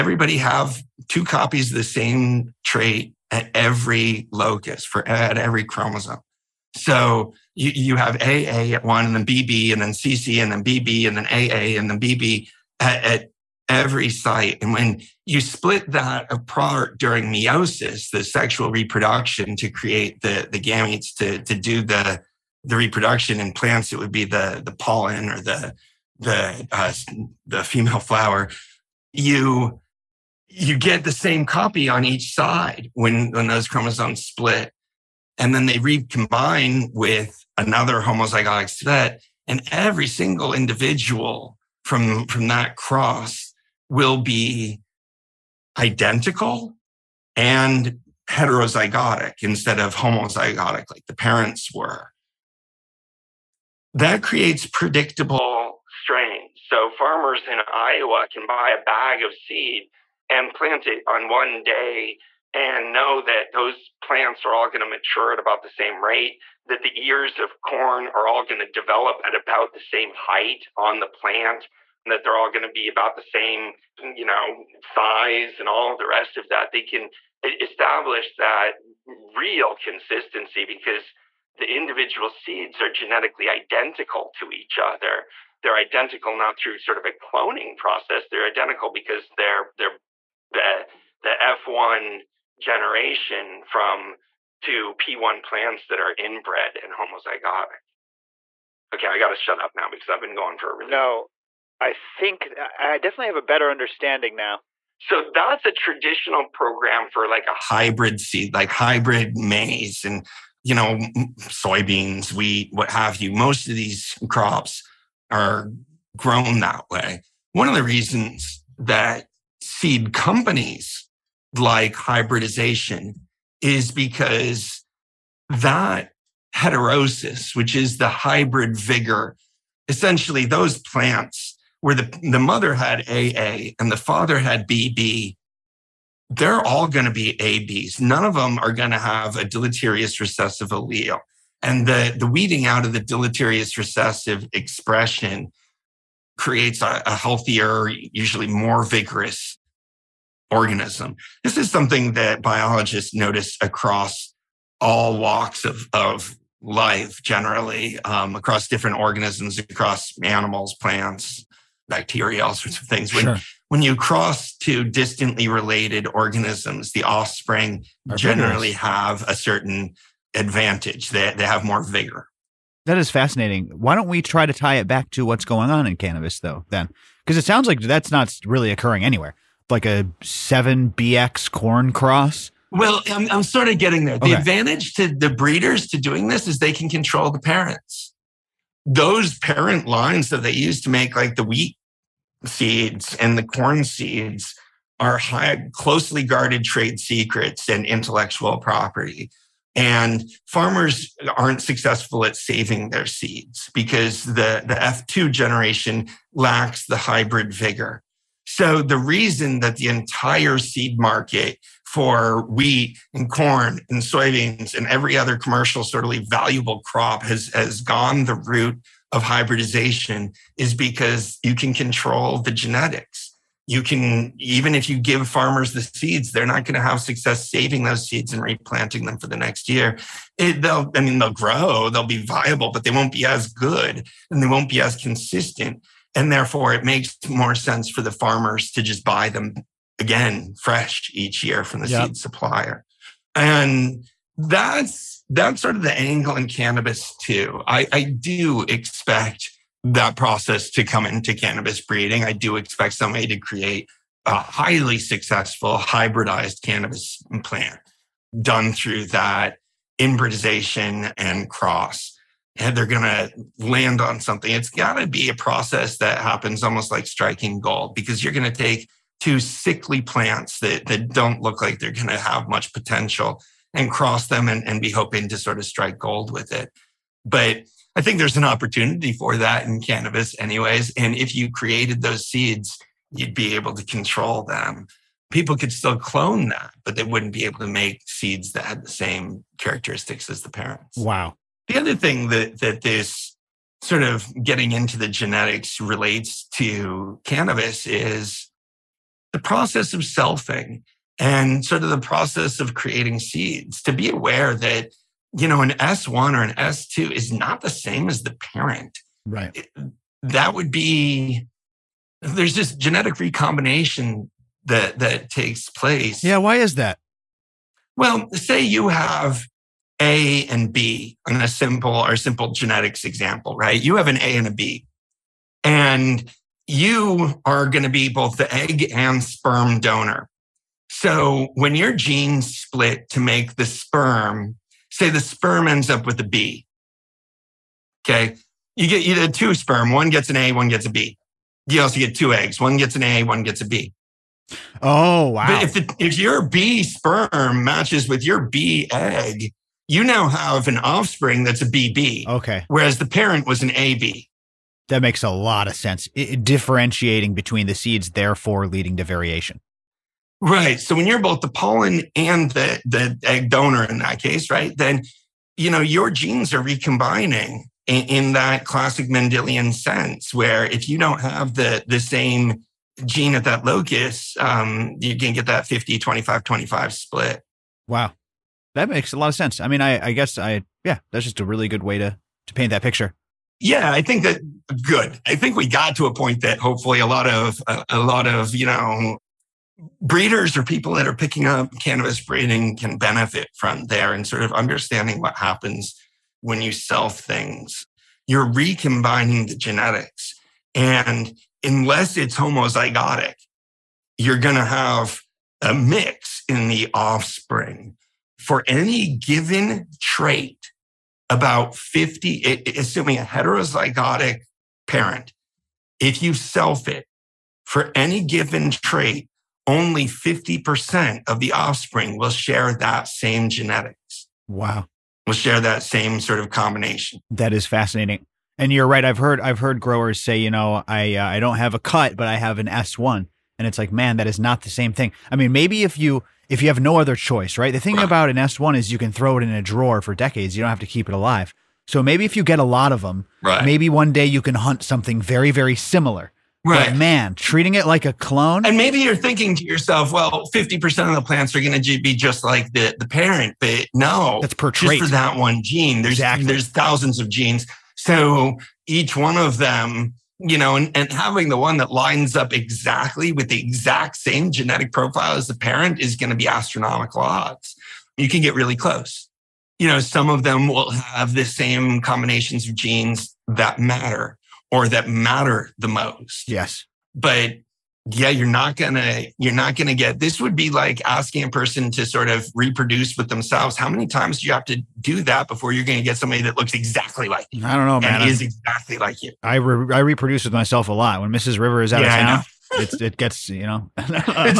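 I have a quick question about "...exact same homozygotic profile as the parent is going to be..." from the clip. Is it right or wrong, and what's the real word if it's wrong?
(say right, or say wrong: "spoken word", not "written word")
wrong: "genetic", not "homozygotic".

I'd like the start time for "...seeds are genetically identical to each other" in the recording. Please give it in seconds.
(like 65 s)
82 s.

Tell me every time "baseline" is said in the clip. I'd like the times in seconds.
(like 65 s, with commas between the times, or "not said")
not said.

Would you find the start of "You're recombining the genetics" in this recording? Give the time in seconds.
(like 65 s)
398 s.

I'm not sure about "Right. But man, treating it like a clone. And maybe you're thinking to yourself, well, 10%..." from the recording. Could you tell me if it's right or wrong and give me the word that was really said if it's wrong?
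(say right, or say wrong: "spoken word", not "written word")
wrong: "50", not "10".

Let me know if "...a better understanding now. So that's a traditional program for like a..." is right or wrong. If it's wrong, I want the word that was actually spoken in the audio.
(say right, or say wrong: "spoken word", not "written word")
right.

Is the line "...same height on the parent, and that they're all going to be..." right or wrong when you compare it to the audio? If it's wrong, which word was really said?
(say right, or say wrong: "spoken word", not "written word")
wrong: "plant", not "parent".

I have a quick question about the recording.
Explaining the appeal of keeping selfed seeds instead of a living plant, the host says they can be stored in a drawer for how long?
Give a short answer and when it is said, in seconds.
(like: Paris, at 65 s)
decades, at 440 s.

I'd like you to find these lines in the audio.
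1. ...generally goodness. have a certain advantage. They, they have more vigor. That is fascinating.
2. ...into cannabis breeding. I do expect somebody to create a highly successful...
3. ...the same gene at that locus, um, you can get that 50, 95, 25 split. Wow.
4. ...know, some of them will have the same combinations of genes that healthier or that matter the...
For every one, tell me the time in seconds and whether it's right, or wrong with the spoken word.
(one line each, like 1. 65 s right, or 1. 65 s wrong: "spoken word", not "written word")
1. 168 s right
2. 251 s right
3. 371 s wrong: "25", not "95"
4. 469 s wrong: "matter", not "healthier".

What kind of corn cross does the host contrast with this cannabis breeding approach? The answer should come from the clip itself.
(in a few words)
7BX corn cross.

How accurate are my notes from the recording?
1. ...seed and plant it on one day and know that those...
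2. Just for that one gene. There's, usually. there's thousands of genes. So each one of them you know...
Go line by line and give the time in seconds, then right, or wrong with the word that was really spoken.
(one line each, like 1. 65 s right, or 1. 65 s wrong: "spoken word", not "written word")
1. 59 s right
2. 454 s wrong: "exactly", not "usually".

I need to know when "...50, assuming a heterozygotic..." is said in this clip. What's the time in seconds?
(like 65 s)
411 s.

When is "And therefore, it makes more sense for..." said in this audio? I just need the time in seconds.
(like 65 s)
236 s.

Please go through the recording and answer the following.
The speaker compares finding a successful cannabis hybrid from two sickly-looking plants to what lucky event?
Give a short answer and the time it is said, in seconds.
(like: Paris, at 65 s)
striking gold, at 267 s.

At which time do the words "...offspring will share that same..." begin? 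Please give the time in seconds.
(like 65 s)
421 s.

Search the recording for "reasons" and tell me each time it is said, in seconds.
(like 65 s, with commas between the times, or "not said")
117 s, 208 s.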